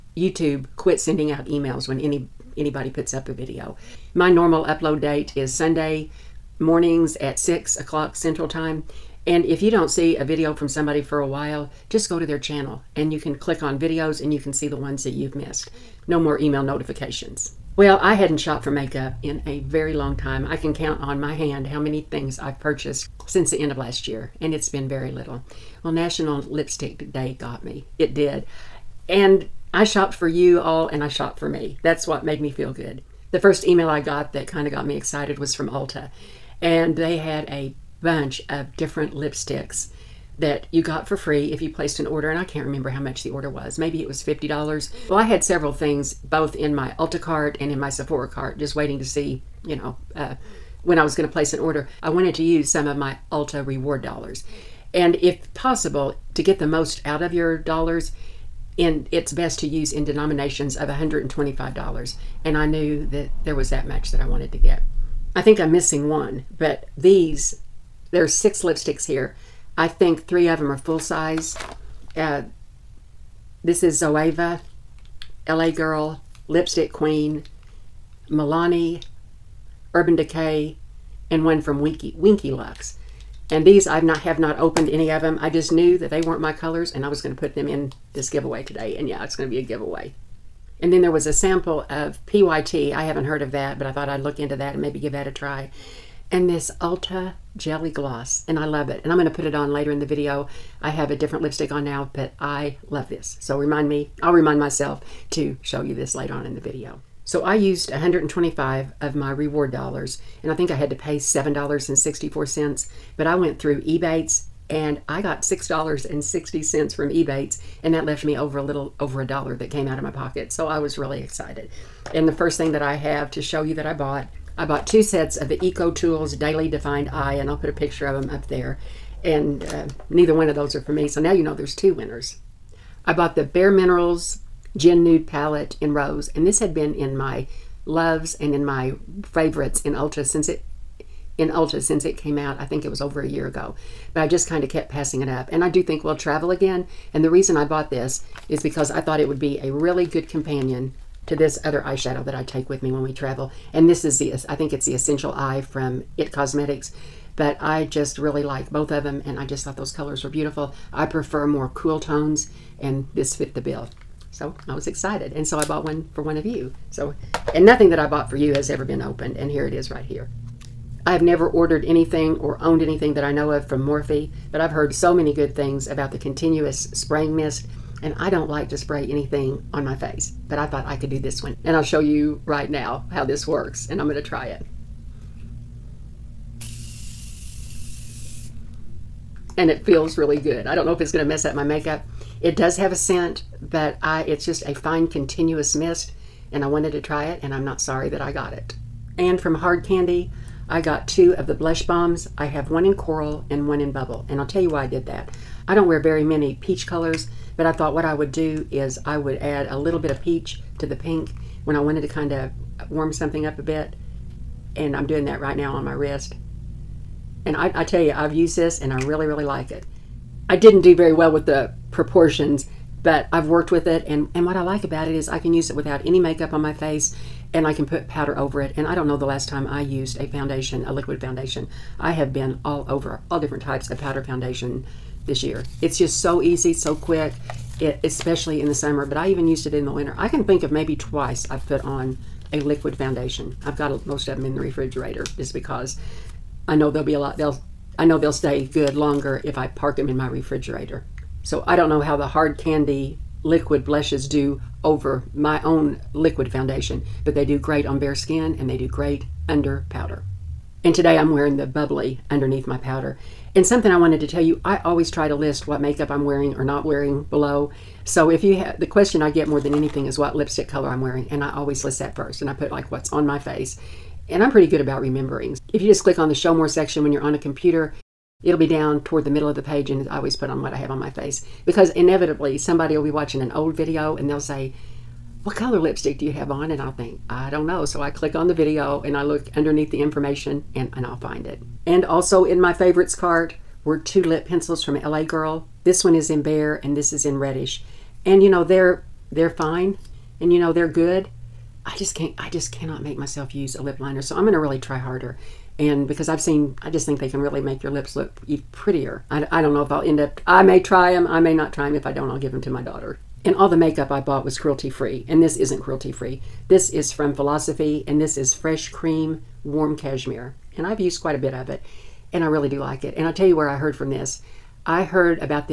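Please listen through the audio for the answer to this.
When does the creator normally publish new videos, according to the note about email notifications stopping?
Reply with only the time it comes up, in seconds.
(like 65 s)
5 s.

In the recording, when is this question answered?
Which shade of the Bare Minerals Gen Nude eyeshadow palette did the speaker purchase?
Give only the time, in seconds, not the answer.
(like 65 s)
135 s.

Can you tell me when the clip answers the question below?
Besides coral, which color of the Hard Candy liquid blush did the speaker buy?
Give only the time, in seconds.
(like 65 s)
203 s.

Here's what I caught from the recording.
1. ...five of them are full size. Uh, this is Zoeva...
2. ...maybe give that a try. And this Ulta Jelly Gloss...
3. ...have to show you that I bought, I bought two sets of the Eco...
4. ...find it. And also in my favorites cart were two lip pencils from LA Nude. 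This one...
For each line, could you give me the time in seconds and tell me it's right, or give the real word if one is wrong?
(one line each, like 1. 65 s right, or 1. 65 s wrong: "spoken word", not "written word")
1. 70 s wrong: "three", not "five"
2. 94 s right
3. 122 s right
4. 291 s wrong: "Girl", not "Nude".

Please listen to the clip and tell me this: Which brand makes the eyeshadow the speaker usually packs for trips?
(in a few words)
IT Cosmetics.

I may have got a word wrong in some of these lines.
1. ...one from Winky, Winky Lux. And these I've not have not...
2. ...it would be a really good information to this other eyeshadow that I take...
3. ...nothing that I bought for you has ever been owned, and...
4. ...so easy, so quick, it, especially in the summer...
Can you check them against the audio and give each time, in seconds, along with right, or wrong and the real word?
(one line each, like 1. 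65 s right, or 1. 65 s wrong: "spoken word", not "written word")
1. 81 s right
2. 149 s wrong: "companion", not "information"
3. 167 s wrong: "opened", not "owned"
4. 236 s right.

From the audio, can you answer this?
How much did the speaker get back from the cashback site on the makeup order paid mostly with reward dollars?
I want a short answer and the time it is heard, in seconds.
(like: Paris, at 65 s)
$6.60, at 115 s.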